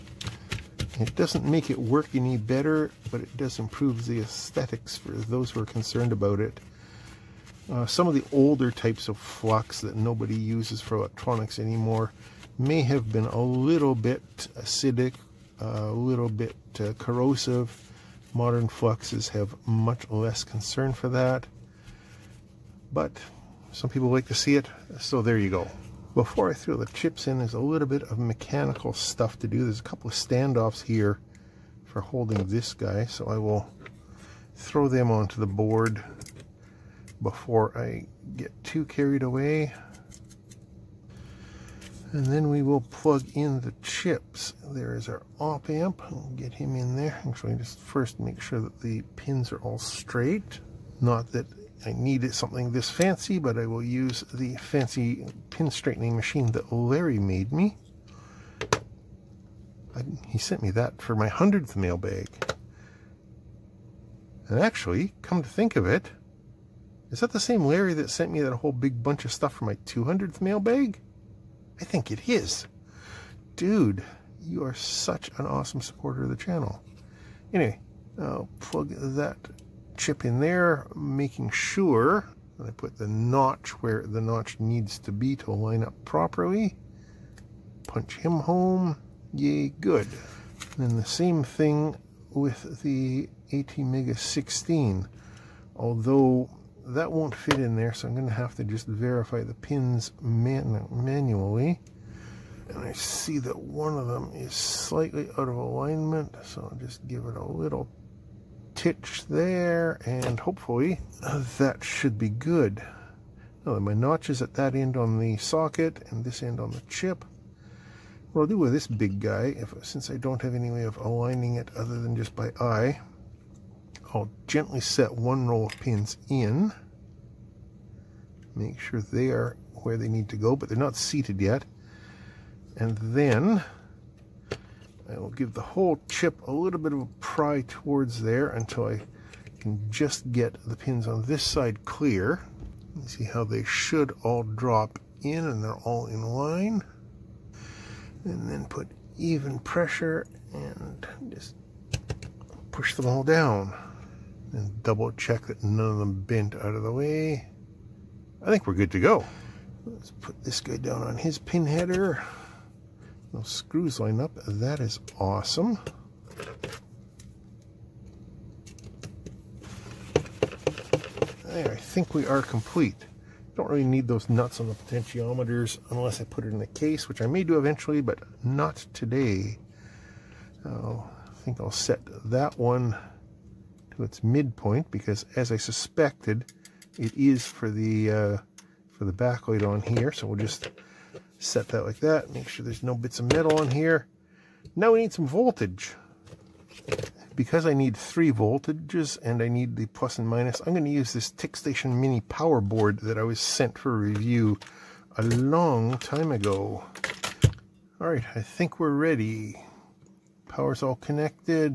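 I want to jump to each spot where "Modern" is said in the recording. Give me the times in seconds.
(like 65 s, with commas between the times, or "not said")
18 s.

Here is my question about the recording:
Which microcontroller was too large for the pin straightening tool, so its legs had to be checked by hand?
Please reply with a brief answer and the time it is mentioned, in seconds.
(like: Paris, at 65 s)
AT Mega 16, at 93 s.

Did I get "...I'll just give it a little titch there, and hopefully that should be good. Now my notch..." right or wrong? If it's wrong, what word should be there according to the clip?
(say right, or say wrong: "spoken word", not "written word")
right.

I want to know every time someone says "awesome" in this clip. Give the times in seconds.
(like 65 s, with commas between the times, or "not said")
75 s, 165 s.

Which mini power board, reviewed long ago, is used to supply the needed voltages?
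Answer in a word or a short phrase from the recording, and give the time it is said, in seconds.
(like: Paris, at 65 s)
TickStation, at 201 s.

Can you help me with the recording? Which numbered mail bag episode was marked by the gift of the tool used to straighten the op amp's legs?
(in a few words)
100th.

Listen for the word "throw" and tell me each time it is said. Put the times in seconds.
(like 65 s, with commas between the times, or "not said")
26 s, 34 s.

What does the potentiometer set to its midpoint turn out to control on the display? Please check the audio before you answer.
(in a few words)
the backlight.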